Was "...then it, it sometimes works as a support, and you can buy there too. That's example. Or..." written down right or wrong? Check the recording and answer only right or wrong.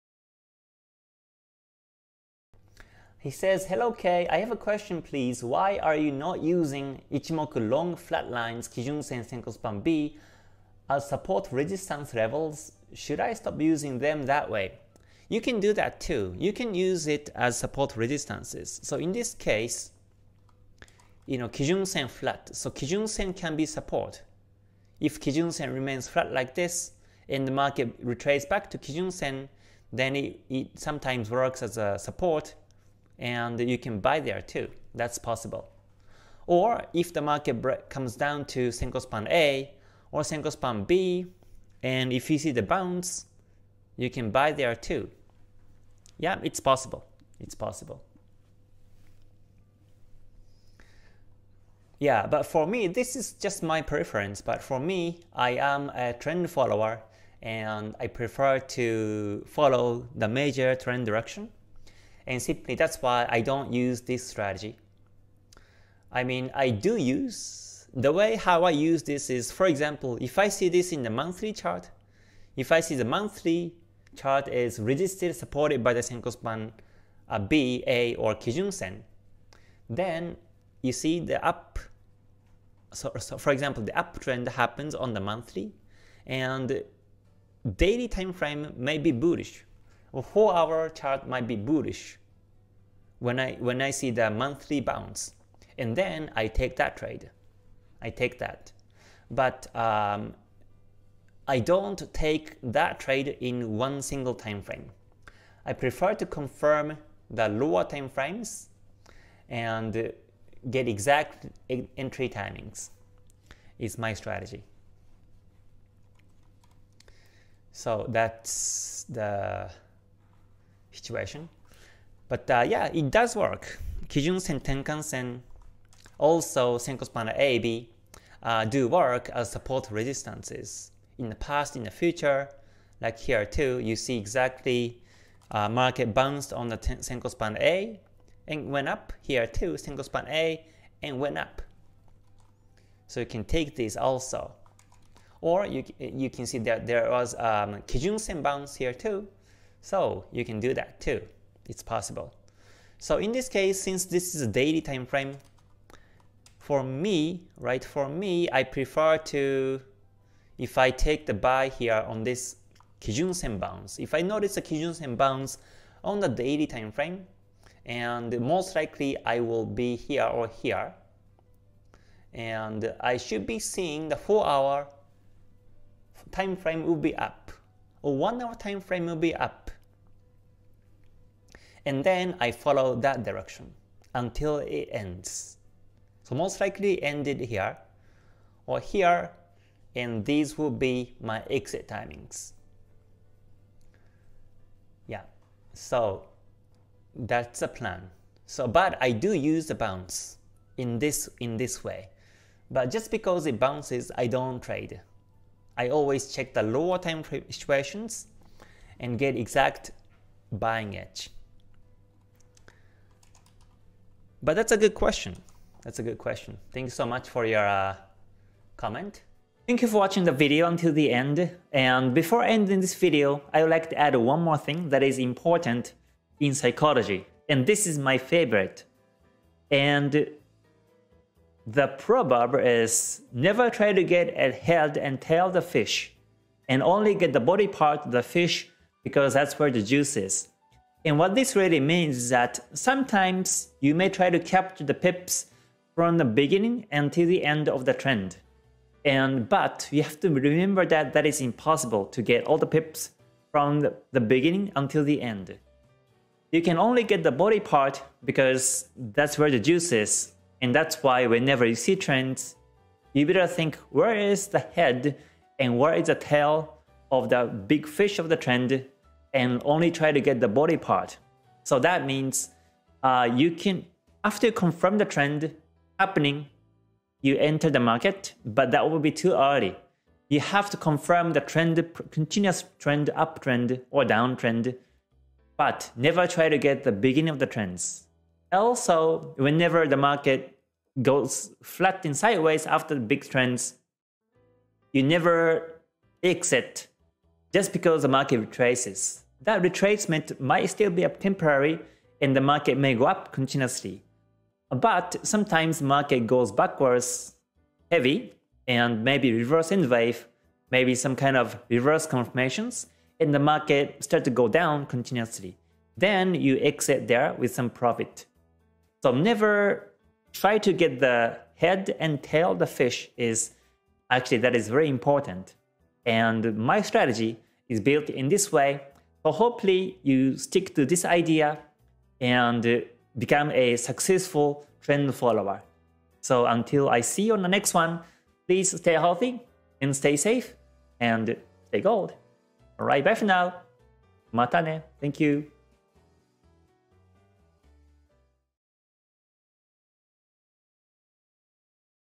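wrong.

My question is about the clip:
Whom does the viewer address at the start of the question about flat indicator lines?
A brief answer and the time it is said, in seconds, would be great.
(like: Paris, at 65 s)
Kei, at 3 s.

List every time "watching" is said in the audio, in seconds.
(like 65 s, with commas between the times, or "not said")
219 s.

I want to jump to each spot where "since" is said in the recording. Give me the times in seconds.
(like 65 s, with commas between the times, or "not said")
153 s.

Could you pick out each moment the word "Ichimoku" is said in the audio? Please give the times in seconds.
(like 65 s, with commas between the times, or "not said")
7 s.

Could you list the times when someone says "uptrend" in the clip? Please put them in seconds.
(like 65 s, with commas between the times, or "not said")
83 s, 283 s.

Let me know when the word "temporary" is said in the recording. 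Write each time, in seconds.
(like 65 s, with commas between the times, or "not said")
301 s.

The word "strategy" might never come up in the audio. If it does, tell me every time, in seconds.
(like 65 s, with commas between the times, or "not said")
64 s, 114 s, 326 s.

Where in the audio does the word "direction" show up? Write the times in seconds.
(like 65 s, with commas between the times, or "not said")
61 s, 183 s.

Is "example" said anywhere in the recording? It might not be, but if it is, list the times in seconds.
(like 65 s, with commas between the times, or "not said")
69 s, 83 s.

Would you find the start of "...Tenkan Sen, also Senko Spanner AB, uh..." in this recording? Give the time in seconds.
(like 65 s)
124 s.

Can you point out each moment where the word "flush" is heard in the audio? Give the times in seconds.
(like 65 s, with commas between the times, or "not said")
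not said.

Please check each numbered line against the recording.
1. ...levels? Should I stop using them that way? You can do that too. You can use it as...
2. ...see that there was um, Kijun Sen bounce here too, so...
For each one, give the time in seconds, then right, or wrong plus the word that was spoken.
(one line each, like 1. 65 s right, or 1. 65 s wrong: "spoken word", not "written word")
1. 12 s right
2. 146 s right.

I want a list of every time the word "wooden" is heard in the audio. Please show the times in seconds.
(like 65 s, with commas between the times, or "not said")
not said.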